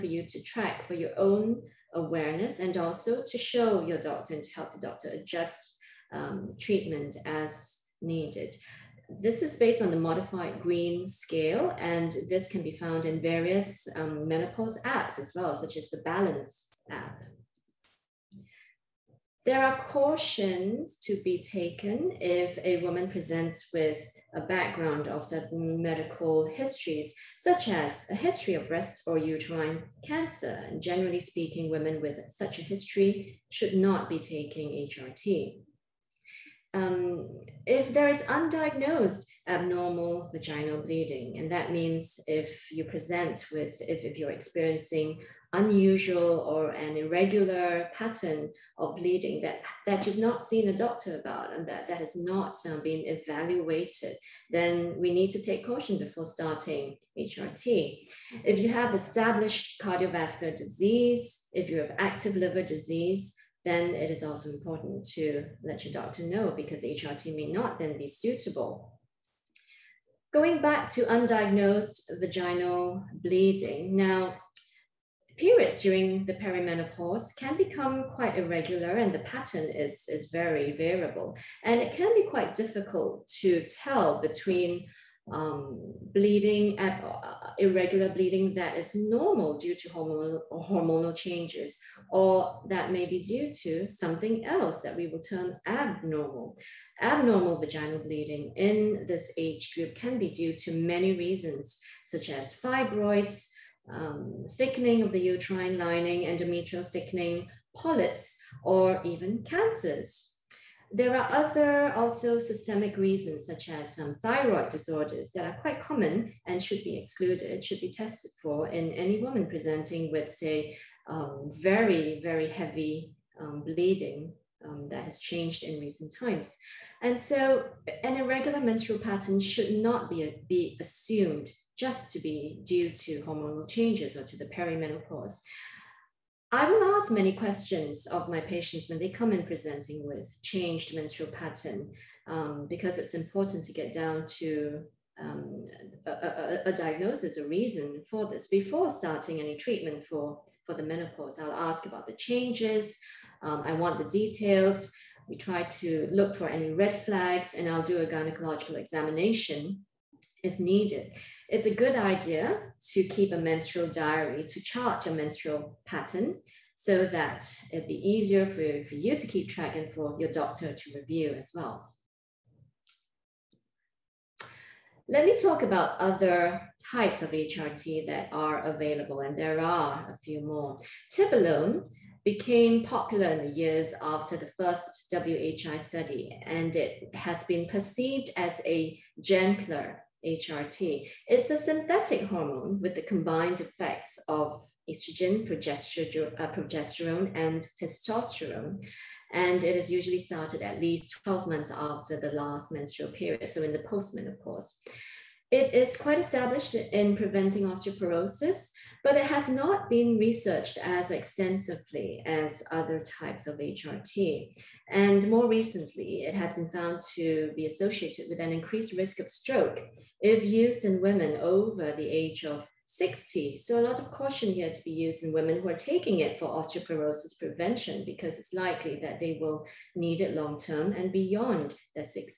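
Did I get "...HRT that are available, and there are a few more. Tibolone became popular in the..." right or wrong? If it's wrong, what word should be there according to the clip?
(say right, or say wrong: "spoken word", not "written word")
right.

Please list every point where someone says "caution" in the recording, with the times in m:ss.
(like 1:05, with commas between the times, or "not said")
0:19, 0:55, 3:44.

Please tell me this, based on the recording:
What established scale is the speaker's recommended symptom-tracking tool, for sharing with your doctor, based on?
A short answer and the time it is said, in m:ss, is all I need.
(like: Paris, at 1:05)
modified Greene scale, at 0:09.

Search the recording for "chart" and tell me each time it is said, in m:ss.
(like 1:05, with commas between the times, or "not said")
2:44.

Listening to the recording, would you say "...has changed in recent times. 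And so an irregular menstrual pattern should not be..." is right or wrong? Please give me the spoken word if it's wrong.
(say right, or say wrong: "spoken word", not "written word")
right.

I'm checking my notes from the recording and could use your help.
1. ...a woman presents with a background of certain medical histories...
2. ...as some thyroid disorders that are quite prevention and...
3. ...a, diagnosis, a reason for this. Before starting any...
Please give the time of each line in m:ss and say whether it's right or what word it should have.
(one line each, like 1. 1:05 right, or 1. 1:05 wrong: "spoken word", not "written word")
1. 0:22 right
2. 1:53 wrong: "common", not "prevention"
3. 2:26 right.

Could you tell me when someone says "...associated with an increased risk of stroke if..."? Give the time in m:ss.
3:37.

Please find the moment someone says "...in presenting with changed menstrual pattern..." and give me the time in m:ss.
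2:19.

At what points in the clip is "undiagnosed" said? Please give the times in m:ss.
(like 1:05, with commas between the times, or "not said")
0:38, 1:11.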